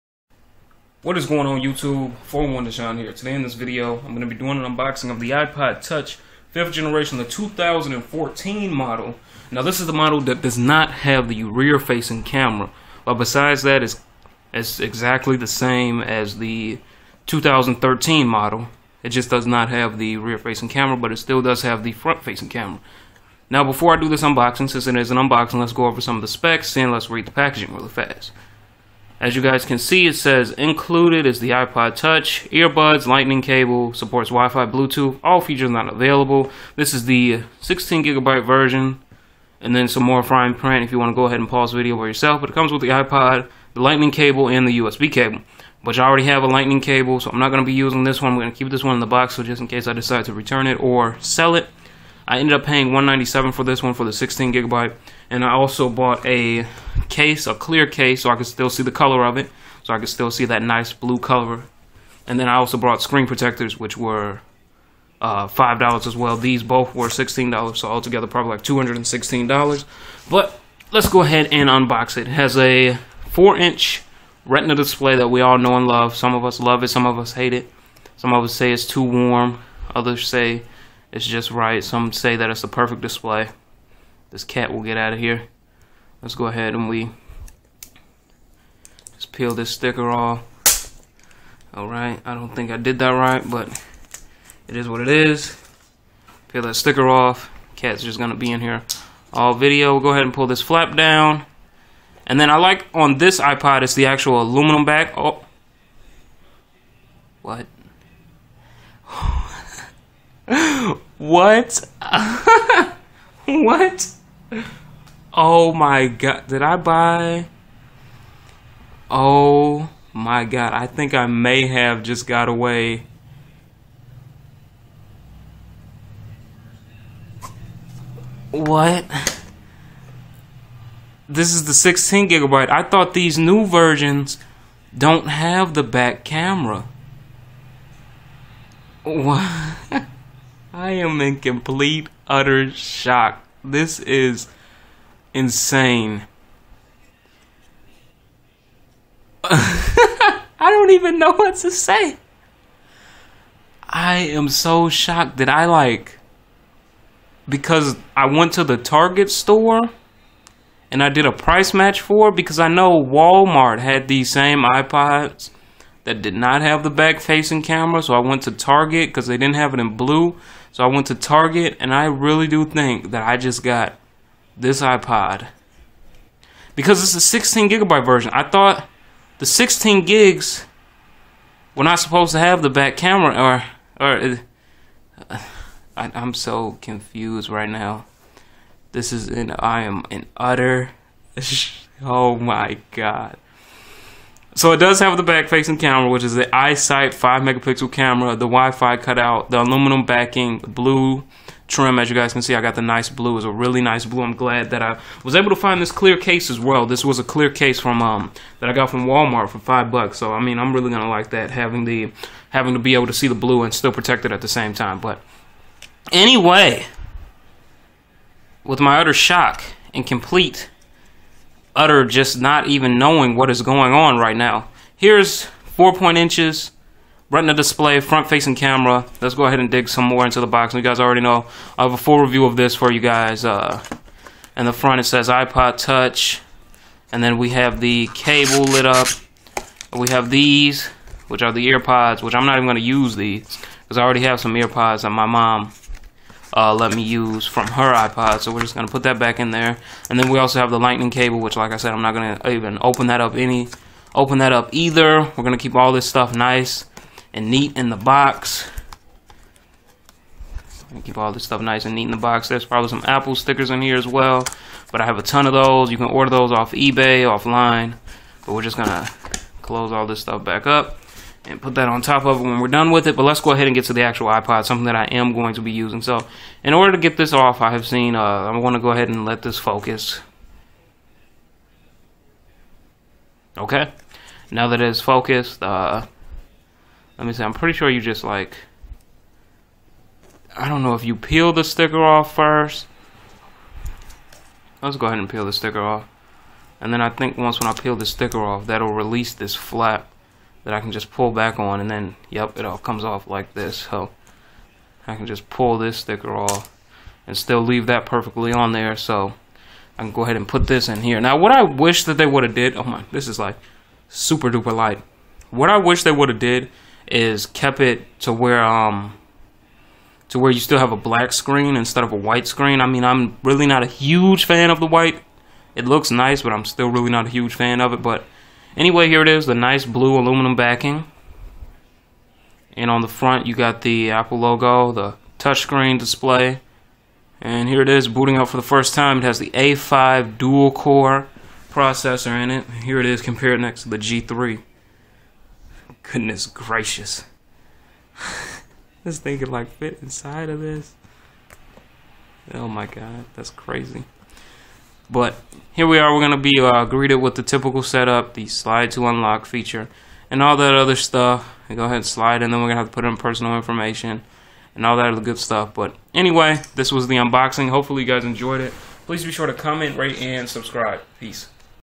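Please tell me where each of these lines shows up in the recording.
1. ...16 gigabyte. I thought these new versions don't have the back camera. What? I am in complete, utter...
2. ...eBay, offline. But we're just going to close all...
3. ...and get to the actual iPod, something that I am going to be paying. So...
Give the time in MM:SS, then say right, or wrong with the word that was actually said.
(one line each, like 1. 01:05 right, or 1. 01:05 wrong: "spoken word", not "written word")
1. 02:11 right
2. 04:26 right
3. 04:33 wrong: "using", not "paying".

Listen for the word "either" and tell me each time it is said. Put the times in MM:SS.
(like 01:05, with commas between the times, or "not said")
04:14.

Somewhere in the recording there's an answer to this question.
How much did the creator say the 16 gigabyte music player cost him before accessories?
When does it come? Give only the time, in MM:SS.
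00:52.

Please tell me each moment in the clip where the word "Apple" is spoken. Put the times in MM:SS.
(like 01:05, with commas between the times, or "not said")
04:23, 05:34.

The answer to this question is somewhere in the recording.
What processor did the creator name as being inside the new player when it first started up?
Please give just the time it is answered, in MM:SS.
05:39.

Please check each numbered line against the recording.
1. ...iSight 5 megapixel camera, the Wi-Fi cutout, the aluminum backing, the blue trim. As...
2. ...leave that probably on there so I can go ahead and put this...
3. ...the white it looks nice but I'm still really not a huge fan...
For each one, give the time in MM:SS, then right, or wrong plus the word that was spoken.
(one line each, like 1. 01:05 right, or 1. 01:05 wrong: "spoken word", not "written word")
1. 03:16 right
2. 05:07 wrong: "perfectly", not "probably"
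3. 05:24 right.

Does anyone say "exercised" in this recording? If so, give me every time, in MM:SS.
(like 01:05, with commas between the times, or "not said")
not said.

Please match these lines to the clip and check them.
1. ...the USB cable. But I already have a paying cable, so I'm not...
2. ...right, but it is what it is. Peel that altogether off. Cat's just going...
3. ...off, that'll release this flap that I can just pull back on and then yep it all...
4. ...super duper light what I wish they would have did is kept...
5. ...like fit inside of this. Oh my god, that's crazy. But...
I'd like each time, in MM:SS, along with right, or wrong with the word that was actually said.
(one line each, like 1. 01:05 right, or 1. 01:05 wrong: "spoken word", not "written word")
1. 00:44 wrong: "lightning", not "paying"
2. 01:33 wrong: "sticker", not "altogether"
3. 04:58 right
4. 05:14 right
5. 05:49 right.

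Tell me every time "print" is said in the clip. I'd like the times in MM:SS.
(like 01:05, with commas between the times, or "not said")
00:40.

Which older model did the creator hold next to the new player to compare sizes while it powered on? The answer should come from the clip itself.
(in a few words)
G3.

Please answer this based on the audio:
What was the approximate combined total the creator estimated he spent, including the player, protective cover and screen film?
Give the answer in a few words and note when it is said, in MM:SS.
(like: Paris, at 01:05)
$216, at 01:08.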